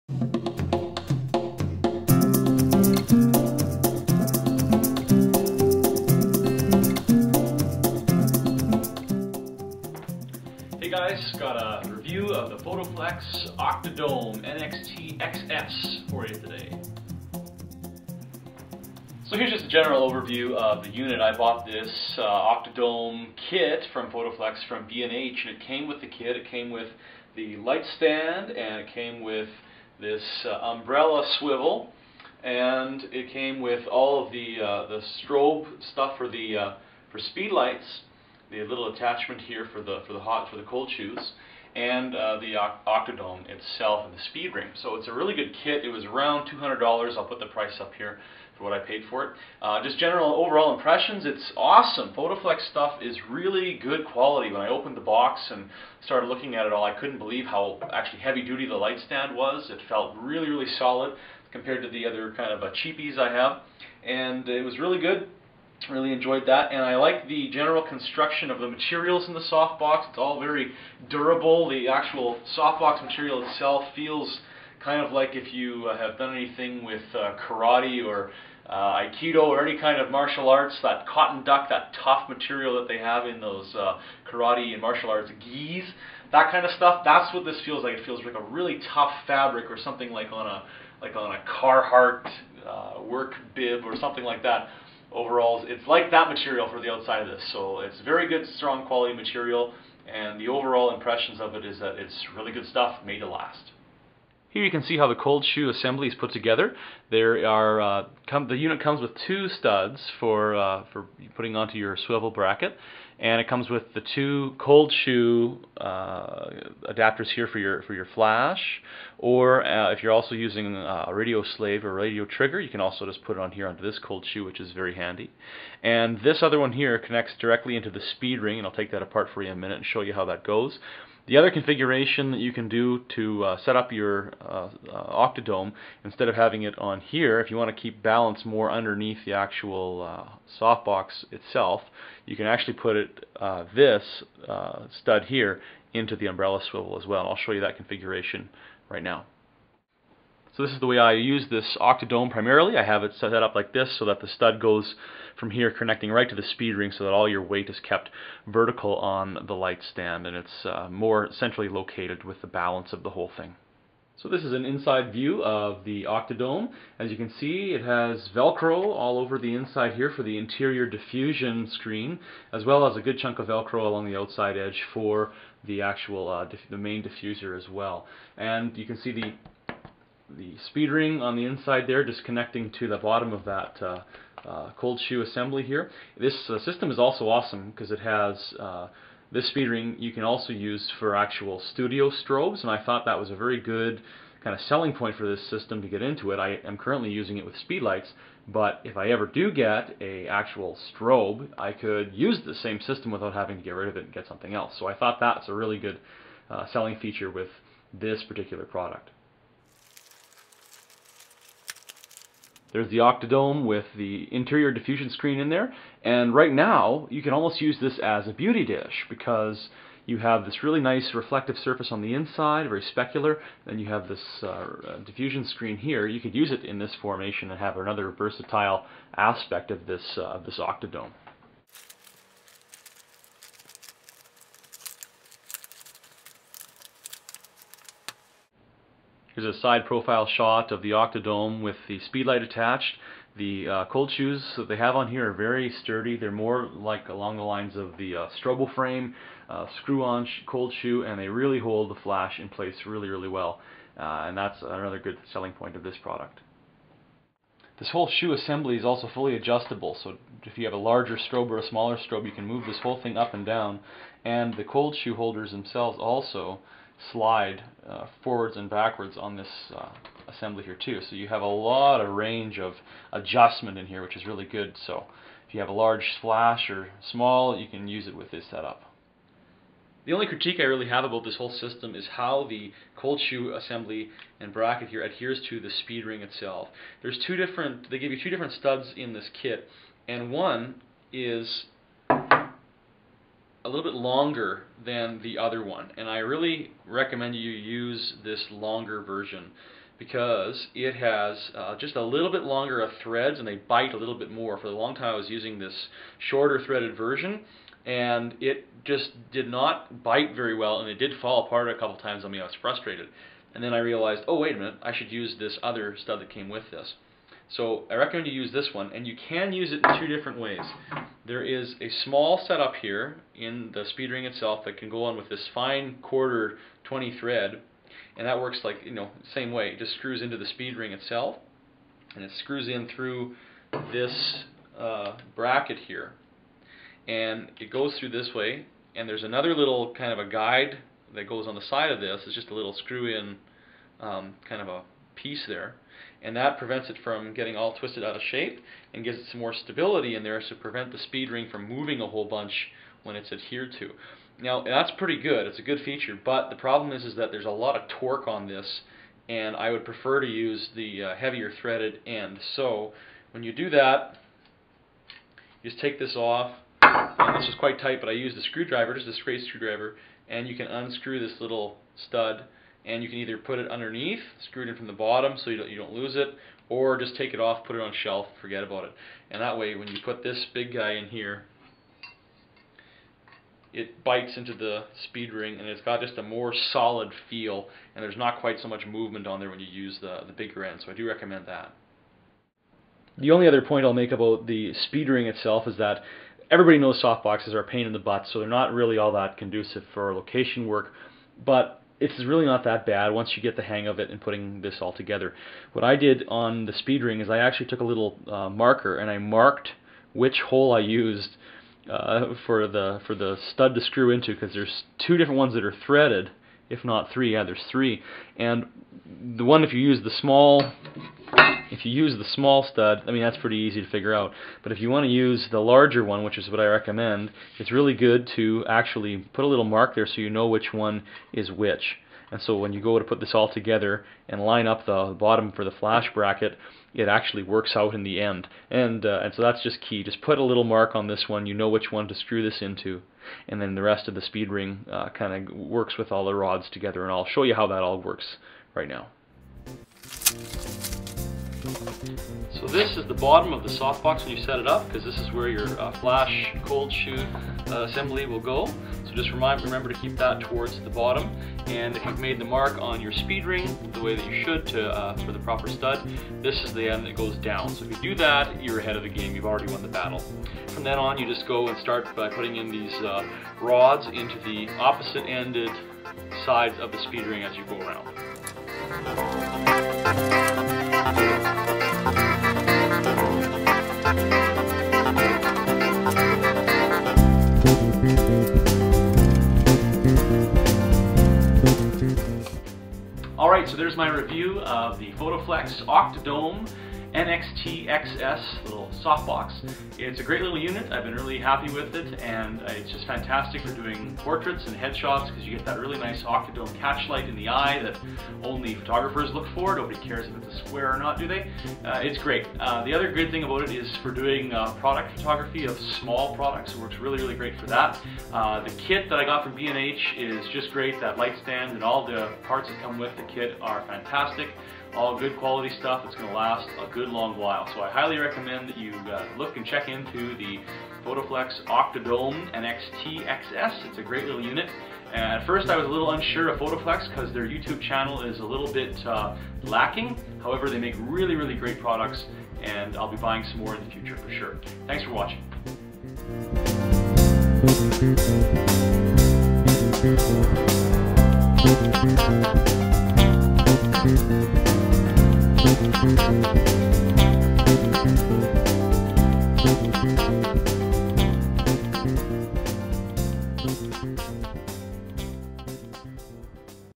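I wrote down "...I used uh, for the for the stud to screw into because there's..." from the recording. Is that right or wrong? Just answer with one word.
right.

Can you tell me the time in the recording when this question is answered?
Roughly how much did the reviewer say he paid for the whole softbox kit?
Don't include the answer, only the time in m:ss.
0:46.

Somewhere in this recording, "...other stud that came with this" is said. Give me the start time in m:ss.
5:15.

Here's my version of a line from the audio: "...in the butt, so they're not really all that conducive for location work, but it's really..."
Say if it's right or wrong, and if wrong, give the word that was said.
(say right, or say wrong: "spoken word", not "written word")
right.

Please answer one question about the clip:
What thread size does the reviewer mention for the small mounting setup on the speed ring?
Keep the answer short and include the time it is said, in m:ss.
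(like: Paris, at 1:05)
quarter 20, at 5:26.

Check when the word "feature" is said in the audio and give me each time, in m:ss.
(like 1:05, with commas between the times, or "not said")
3:26, 5:55.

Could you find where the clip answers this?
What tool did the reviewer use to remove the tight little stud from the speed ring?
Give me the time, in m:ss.
6:09.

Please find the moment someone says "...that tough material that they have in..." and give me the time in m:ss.
1:21.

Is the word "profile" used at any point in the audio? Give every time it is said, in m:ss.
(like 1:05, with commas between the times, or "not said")
3:59.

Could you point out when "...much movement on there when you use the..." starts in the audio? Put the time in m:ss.
6:28.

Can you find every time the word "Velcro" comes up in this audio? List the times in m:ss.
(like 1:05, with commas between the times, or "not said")
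2:48, 2:53.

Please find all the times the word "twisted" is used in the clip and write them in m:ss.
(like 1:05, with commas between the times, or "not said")
5:47.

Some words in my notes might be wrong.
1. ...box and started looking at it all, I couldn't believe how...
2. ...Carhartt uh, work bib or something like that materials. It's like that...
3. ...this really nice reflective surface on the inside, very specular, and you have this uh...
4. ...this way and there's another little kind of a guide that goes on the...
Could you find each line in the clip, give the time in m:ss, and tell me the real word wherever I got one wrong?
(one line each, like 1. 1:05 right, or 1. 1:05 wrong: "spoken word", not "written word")
1. 0:55 right
2. 1:31 wrong: "overalls", not "materials"
3. 3:40 right
4. 5:38 right.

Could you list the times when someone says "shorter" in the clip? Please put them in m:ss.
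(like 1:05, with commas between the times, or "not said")
5:06.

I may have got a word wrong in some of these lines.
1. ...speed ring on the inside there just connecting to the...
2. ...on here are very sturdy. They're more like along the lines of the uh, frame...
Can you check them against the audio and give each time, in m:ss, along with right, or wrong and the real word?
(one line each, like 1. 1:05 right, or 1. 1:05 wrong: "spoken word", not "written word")
1. 3:00 right
2. 4:04 right.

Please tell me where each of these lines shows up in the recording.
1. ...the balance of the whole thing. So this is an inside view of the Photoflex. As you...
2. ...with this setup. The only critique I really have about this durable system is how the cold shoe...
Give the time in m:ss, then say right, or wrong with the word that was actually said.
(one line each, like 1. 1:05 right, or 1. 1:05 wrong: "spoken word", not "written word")
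1. 2:42 wrong: "Octodome", not "Photoflex"
2. 4:38 wrong: "whole", not "durable".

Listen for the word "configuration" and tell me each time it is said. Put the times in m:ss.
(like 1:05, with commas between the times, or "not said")
2:11, 2:27.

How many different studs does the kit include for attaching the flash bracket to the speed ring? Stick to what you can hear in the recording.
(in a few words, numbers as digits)
2.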